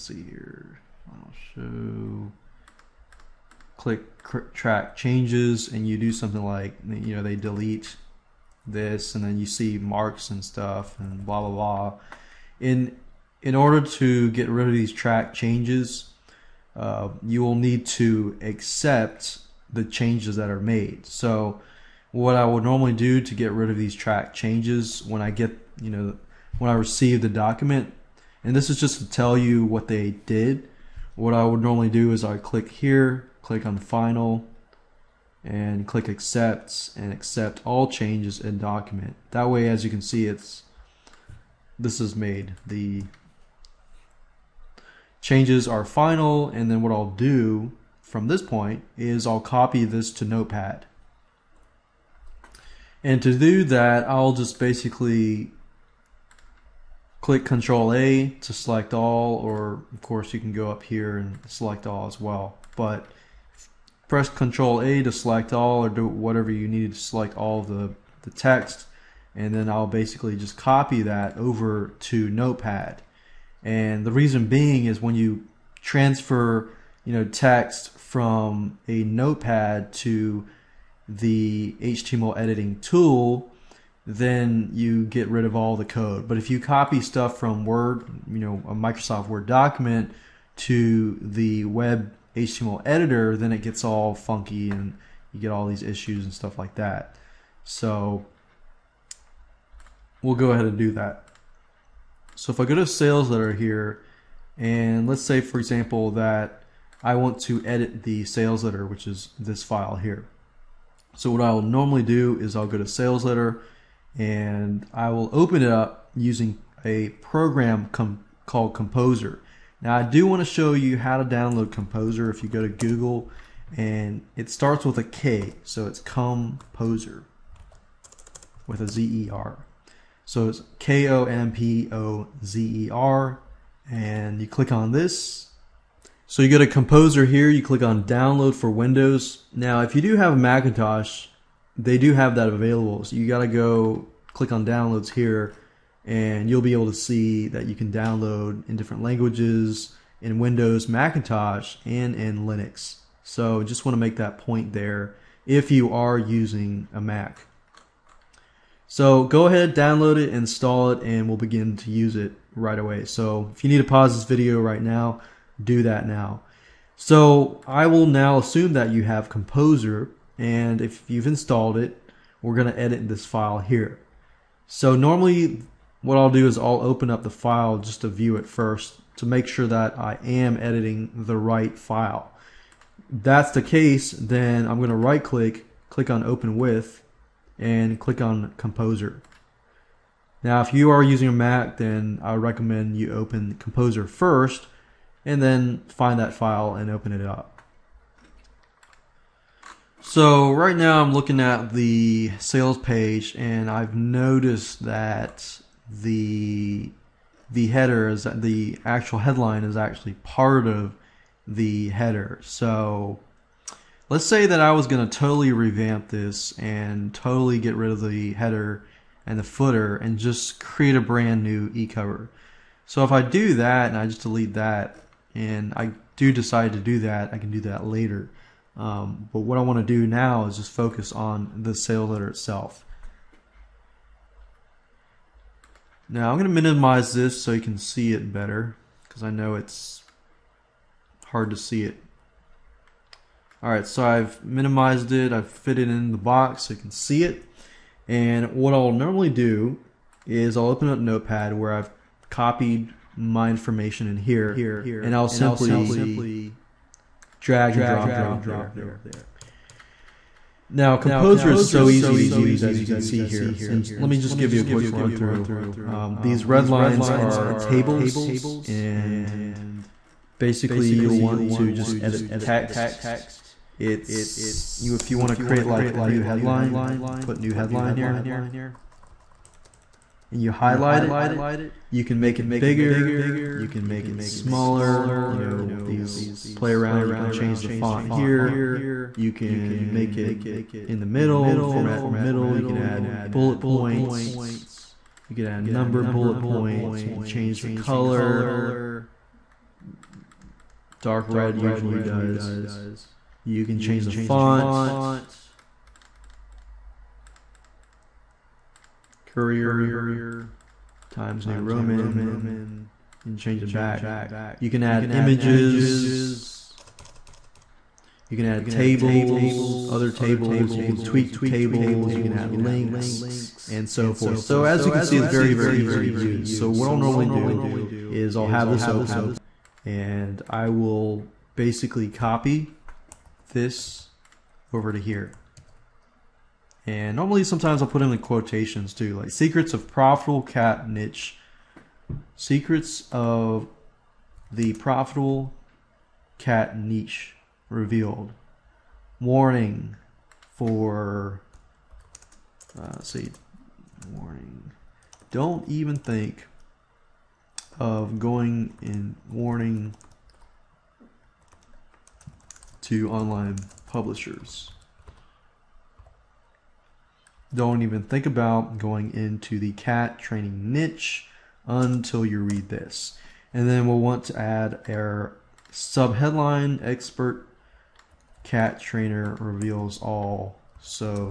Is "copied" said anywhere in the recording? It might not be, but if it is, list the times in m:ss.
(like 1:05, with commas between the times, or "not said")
4:12.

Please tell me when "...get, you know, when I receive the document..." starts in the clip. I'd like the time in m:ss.
0:25.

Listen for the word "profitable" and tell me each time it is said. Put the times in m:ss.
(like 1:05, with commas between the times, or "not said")
5:39, 5:44.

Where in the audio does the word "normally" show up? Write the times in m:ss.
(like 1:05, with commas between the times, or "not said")
0:22, 0:31, 1:51, 2:54, 4:08, 5:26, 5:37.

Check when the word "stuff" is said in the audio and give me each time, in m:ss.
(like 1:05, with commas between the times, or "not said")
0:10, 1:27, 1:36.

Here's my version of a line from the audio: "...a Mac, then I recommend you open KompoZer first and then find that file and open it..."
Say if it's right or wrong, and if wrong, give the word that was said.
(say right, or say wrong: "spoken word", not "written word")
right.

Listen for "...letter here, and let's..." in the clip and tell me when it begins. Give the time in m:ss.
1:43.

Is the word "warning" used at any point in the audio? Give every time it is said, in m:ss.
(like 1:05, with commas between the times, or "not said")
5:49, 5:54, 5:59.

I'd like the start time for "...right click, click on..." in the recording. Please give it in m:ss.
3:04.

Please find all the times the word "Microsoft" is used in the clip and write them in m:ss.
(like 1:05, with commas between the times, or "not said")
1:28.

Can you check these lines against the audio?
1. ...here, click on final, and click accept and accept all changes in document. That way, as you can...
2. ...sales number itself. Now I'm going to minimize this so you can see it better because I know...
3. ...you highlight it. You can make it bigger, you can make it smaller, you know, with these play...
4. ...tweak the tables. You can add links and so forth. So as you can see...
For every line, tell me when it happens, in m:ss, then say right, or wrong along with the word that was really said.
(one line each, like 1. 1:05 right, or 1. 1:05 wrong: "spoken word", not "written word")
1. 0:32 right
2. 3:51 wrong: "letter", not "number"
3. 4:40 right
4. 5:21 right.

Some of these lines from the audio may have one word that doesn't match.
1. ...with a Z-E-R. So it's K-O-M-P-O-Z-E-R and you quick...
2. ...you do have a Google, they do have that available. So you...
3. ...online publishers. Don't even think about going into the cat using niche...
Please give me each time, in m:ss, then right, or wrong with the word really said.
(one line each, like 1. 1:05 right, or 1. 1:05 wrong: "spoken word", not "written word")
1. 2:08 wrong: "click", not "quick"
2. 2:19 wrong: "Macintosh", not "Google"
3. 6:03 wrong: "training", not "using".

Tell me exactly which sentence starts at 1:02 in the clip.
But press Control A to select all or do whatever you need to select all the, the text.